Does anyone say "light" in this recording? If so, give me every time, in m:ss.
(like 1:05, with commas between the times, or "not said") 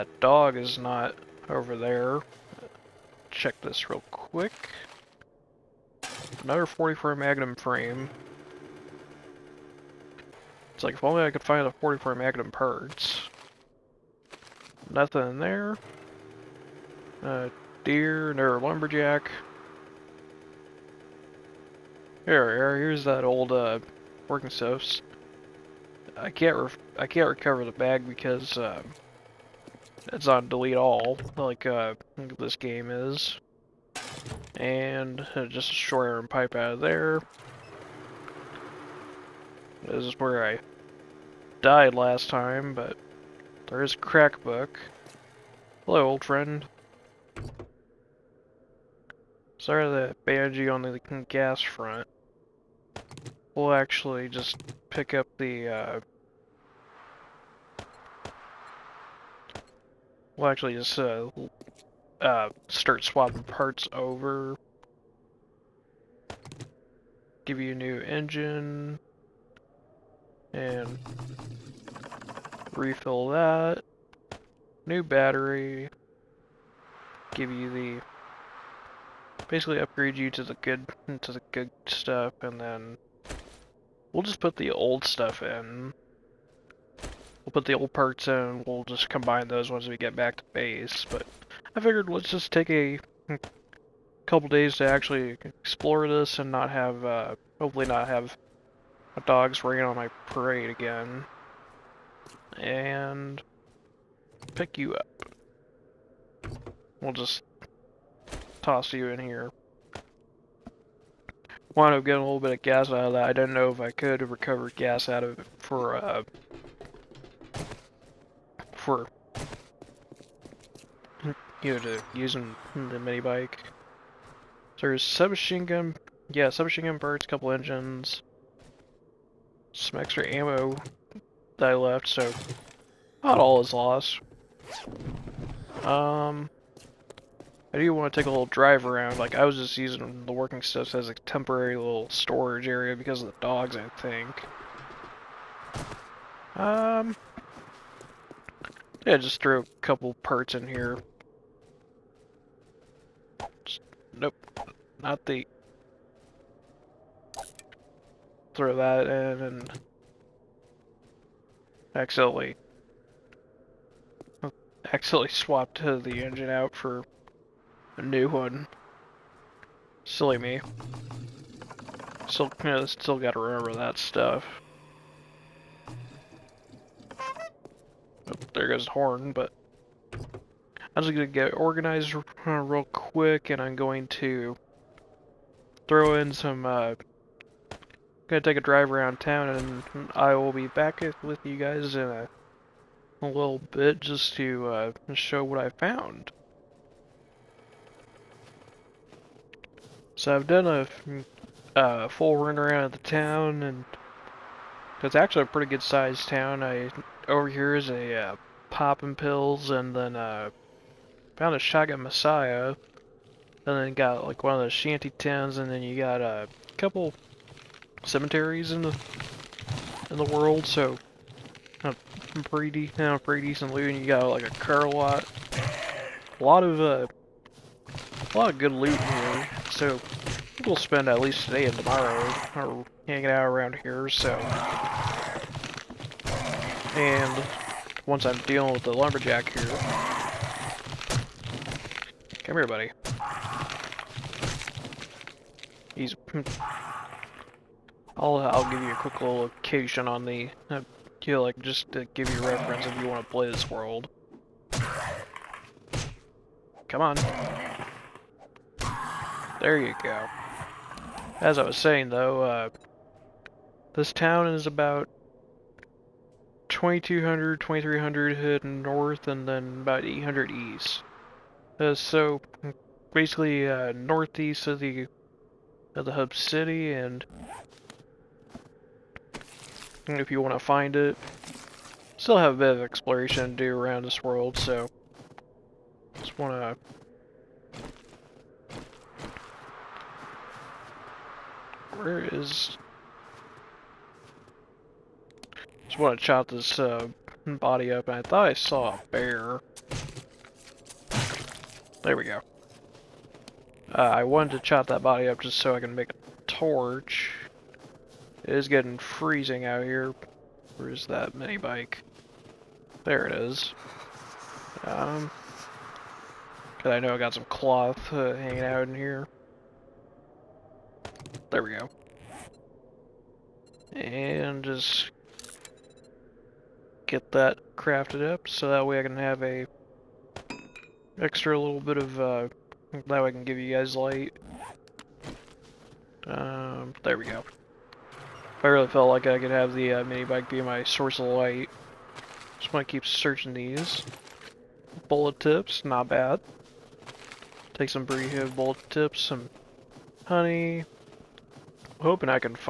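5:33, 5:41.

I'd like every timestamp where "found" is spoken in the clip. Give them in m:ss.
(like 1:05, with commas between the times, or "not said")
3:15, 3:31.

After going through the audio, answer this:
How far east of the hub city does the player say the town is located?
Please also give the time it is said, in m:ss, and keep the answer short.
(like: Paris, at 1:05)
800, at 4:30.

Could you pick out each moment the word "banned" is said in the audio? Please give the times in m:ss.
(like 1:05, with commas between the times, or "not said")
0:50.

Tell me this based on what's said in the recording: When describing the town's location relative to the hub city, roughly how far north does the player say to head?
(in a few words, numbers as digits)
2200-2300.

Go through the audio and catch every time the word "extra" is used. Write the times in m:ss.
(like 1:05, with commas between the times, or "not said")
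2:09, 5:31.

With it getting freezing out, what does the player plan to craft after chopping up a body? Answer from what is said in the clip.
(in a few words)
A torch.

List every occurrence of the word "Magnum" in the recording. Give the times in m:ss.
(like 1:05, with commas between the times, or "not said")
0:07, 0:12.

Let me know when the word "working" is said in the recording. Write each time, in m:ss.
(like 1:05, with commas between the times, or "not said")
0:24, 2:20.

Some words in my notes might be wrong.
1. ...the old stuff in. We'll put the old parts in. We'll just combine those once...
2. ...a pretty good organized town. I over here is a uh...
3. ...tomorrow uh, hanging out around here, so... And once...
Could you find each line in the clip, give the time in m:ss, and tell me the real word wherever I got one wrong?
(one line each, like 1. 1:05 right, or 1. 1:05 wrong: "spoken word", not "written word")
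1. 1:24 right
2. 3:25 wrong: "sized", not "organized"
3. 3:51 right.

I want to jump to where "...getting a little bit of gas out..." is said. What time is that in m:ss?
1:52.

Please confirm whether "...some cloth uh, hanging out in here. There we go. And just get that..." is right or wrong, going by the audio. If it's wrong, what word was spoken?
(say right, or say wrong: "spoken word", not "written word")
right.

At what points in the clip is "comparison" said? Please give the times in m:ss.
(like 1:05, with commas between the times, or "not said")
not said.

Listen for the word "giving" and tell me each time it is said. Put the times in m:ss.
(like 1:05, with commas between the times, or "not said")
not said.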